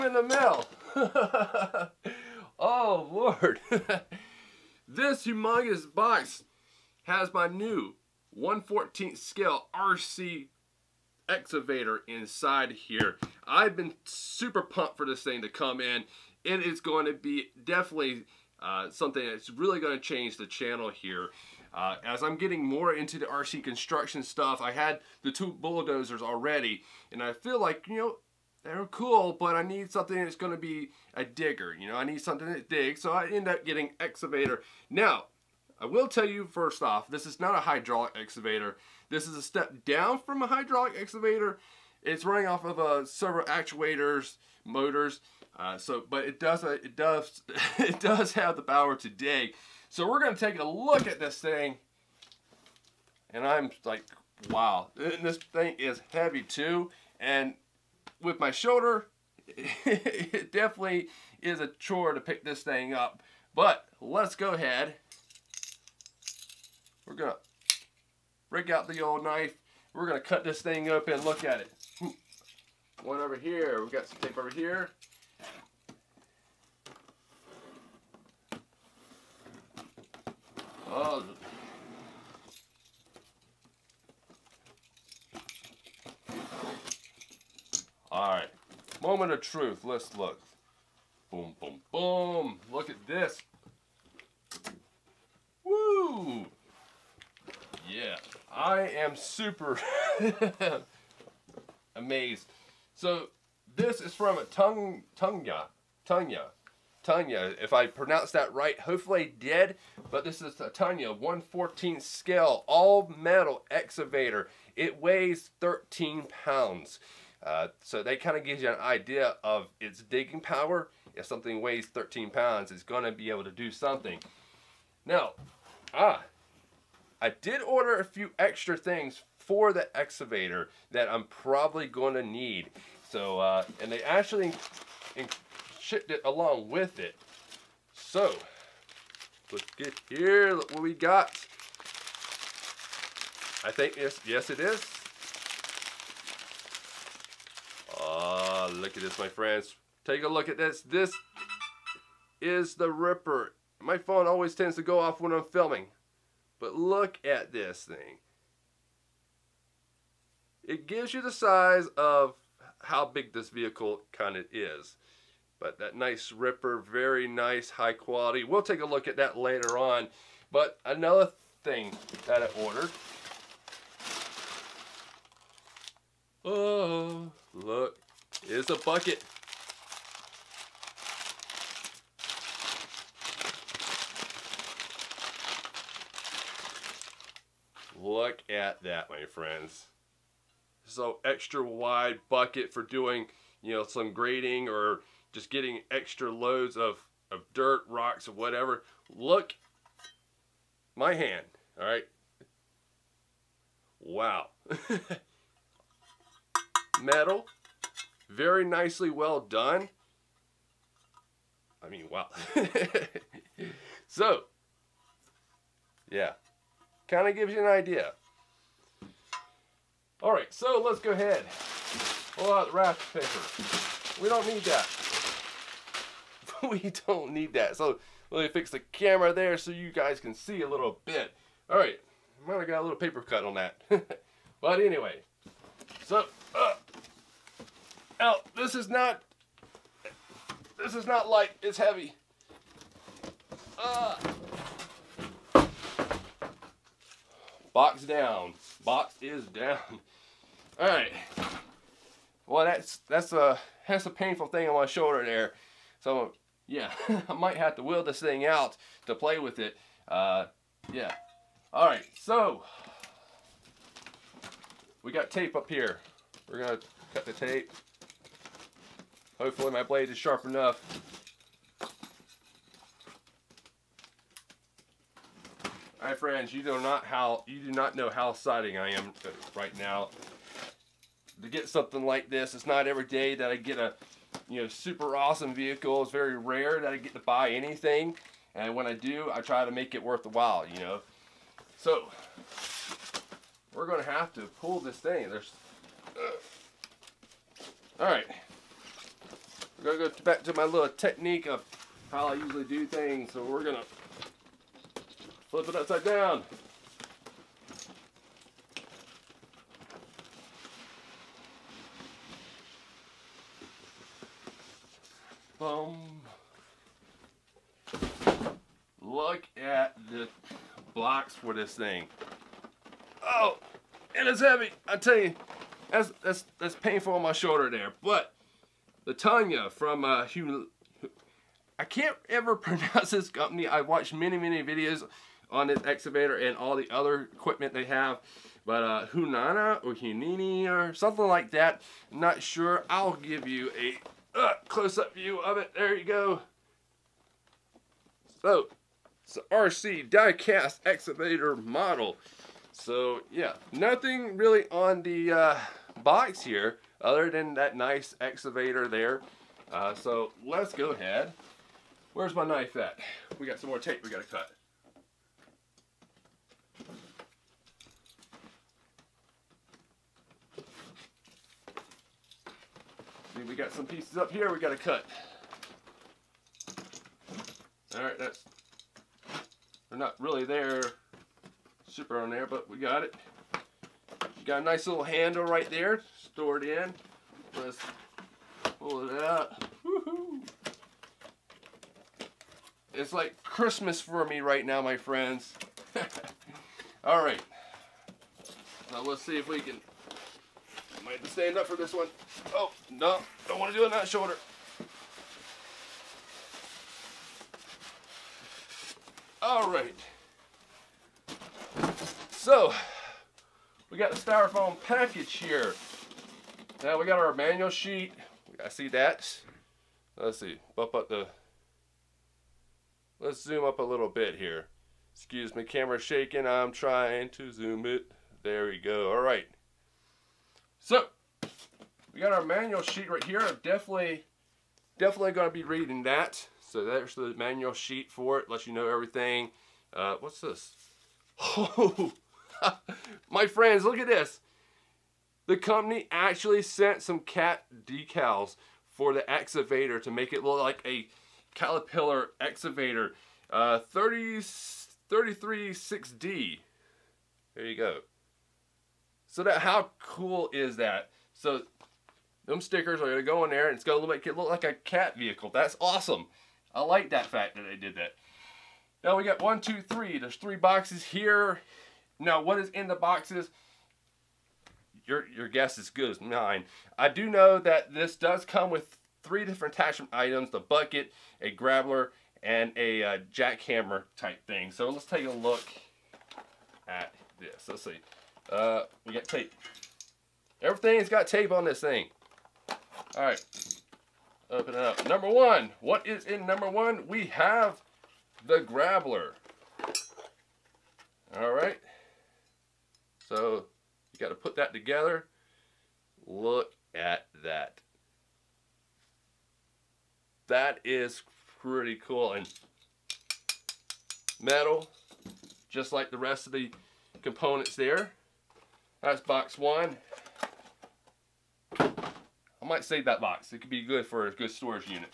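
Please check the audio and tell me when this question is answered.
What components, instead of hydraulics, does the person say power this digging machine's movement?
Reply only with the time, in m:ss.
0:43.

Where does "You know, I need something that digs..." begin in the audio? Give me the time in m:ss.
0:31.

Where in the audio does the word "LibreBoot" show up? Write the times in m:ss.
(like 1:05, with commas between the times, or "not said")
not said.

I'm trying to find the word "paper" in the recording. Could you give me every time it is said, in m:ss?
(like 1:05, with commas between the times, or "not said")
3:43, 3:52.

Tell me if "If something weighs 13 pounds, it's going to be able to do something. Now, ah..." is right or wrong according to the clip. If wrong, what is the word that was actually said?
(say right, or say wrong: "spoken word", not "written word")
right.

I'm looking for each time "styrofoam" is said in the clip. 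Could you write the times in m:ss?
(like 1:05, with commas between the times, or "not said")
6:54.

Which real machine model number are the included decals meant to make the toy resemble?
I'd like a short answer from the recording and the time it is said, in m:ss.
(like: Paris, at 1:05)
336D, at 7:35.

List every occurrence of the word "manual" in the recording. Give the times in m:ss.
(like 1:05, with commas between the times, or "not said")
6:57, 7:12, 7:17.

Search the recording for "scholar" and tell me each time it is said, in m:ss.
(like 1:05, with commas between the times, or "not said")
not said.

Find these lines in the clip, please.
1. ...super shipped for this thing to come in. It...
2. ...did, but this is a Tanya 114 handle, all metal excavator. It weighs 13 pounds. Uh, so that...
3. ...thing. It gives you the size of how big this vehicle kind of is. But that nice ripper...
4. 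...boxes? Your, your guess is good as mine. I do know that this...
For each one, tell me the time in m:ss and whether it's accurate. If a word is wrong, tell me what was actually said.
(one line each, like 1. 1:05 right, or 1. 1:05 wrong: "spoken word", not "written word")
1. 0:14 wrong: "pumped", not "shipped"
2. 1:49 wrong: "scale", not "handle"
3. 2:37 right
4. 7:52 right.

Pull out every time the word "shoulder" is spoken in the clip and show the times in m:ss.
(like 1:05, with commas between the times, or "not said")
0:58, 4:14, 5:27, 6:44.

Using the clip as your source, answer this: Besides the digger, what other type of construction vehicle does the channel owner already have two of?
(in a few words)
bulldozers.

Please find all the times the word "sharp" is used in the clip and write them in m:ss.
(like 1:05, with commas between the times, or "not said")
4:30.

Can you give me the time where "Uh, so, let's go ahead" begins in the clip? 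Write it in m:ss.
5:59.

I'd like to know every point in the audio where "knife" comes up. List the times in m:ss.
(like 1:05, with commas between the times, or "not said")
1:09, 6:02.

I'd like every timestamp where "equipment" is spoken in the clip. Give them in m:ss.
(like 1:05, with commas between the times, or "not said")
5:37.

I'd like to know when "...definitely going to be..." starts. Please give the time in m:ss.
7:14.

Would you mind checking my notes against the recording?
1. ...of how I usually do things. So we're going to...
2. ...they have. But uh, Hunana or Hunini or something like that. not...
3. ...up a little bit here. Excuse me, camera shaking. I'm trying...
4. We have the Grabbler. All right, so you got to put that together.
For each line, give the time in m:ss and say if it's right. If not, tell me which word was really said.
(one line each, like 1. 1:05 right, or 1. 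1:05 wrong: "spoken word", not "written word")
1. 5:01 right
2. 5:37 right
3. 7:03 right
4. 8:17 right.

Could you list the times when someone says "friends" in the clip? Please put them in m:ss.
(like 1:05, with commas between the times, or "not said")
2:29, 3:09, 4:36, 6:34, 7:23.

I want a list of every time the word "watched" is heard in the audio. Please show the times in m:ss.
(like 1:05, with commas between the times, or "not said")
5:33.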